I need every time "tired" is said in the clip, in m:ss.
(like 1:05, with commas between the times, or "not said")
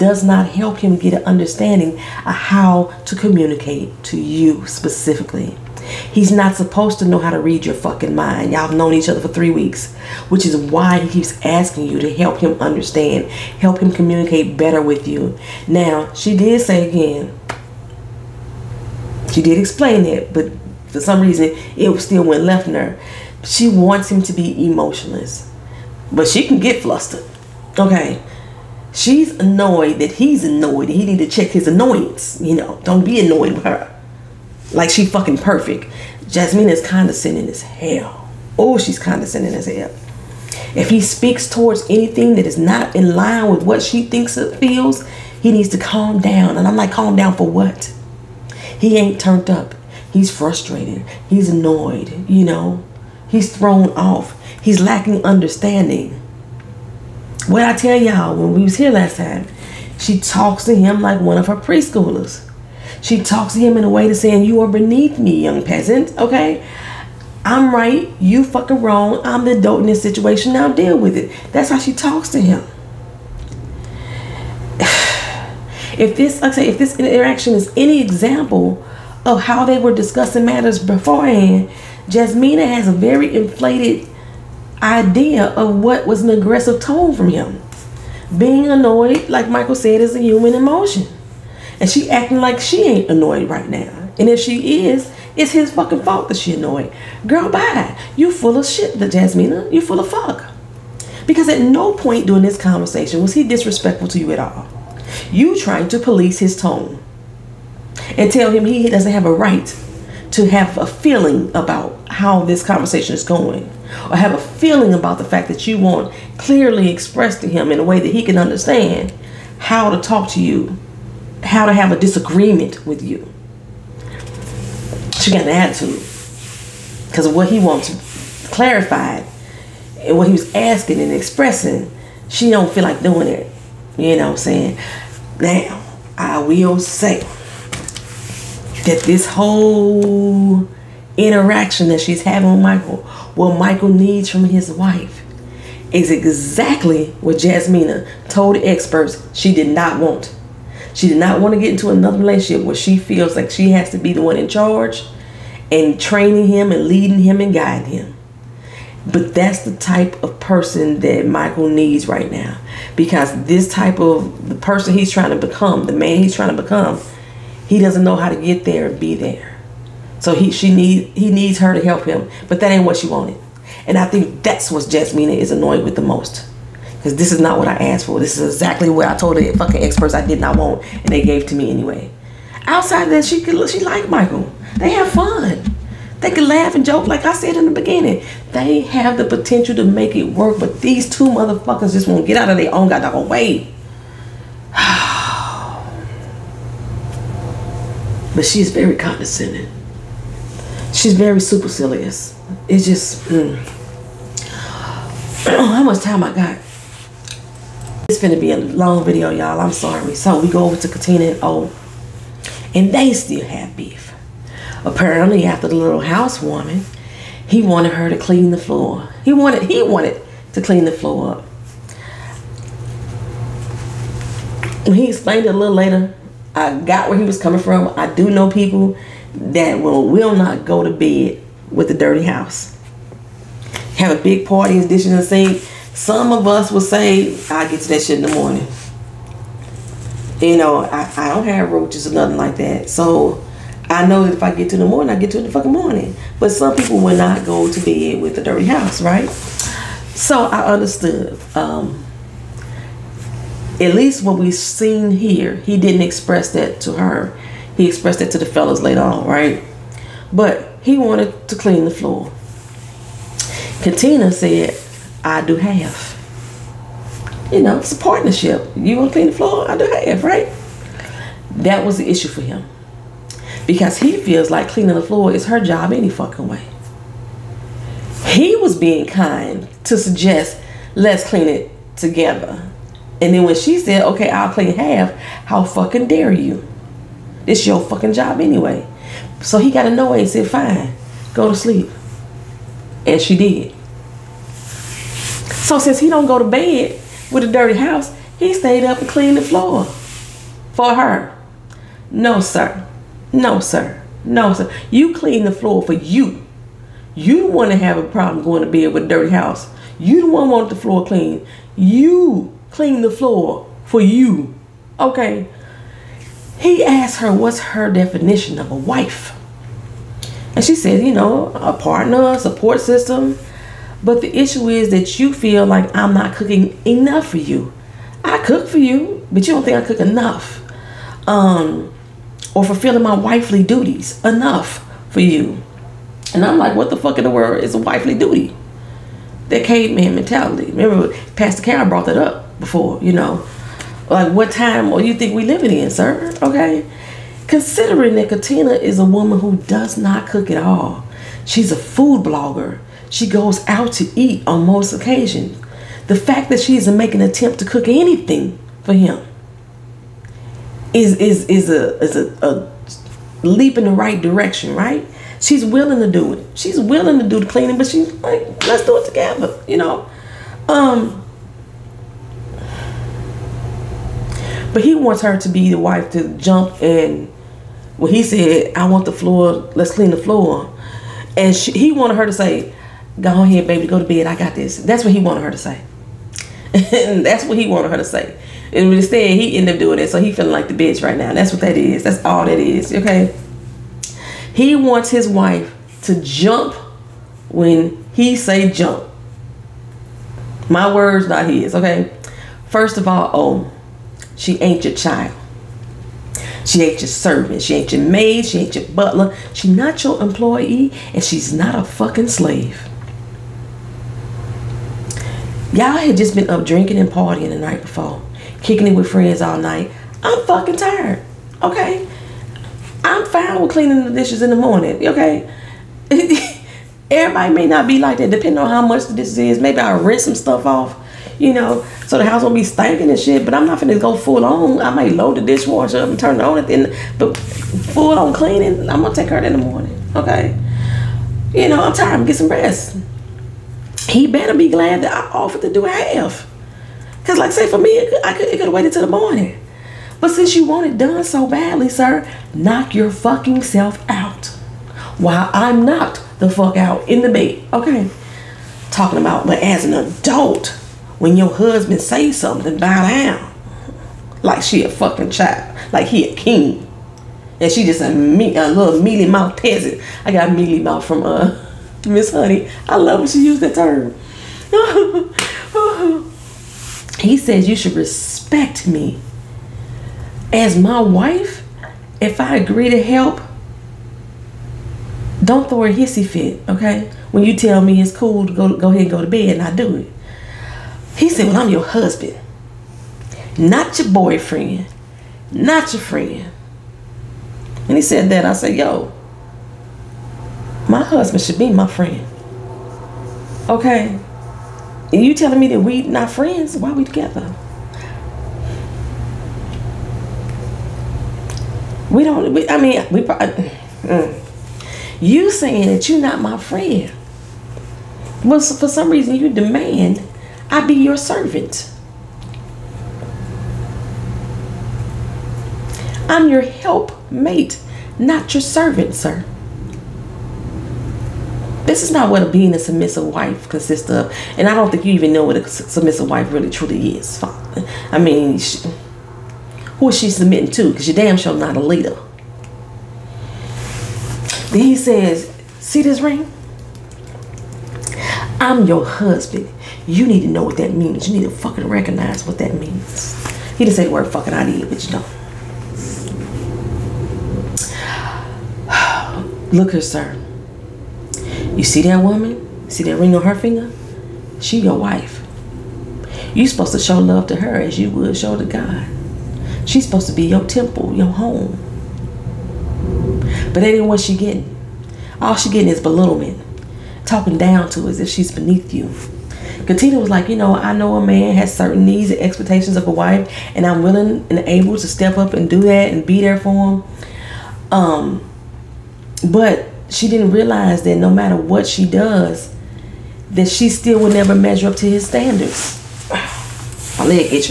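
7:00, 7:21.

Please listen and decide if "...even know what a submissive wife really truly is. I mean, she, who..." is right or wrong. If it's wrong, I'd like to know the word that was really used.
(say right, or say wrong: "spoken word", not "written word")
right.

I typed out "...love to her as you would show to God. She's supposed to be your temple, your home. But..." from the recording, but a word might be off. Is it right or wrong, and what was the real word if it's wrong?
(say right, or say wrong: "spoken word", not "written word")
right.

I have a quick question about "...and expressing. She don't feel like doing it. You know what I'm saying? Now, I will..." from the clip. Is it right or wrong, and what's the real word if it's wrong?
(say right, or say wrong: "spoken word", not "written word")
right.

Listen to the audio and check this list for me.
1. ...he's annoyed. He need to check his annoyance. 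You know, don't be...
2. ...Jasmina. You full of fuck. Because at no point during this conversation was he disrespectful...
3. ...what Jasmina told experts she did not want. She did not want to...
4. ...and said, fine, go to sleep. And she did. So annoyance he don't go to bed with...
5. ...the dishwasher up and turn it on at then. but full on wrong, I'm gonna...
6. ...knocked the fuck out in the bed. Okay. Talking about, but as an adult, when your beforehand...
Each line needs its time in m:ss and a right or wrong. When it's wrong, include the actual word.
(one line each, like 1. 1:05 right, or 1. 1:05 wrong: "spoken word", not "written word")
1. 0:30 right
2. 1:39 right
3. 2:27 right
4. 4:50 wrong: "since", not "annoyance"
5. 7:15 wrong: "cleaning", not "wrong"
6. 7:35 wrong: "husband", not "beforehand".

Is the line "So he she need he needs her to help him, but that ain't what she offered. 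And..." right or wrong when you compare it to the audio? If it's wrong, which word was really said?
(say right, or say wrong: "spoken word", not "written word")
wrong: "wanted", not "offered".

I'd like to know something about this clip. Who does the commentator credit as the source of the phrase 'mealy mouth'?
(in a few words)
Miss Honey.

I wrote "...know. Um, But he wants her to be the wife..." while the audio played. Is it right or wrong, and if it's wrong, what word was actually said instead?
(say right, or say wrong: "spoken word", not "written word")
right.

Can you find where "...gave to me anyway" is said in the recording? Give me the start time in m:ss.
3:01.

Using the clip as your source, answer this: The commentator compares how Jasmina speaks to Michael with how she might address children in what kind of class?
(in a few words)
preschoolers.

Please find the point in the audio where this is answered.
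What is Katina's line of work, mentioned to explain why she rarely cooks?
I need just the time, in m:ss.
5:51.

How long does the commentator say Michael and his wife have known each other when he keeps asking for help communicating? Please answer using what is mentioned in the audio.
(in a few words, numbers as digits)
3 weeks.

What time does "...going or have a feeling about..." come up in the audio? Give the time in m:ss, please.
1:53.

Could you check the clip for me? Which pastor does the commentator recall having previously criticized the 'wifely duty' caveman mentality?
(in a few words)
Pastor Cal.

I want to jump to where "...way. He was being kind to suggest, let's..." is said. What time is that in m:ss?
4:36.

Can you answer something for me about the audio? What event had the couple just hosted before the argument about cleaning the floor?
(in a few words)
housewarming.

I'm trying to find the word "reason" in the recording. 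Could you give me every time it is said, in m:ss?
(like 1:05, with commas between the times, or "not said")
0:21, 8:39.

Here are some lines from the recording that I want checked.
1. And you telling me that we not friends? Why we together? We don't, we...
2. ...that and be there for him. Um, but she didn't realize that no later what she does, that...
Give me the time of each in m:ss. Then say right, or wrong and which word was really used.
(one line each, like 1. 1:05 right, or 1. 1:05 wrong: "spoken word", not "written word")
1. 8:25 right
2. 9:45 wrong: "matter", not "later".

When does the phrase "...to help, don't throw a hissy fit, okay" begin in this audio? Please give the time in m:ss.
8:02.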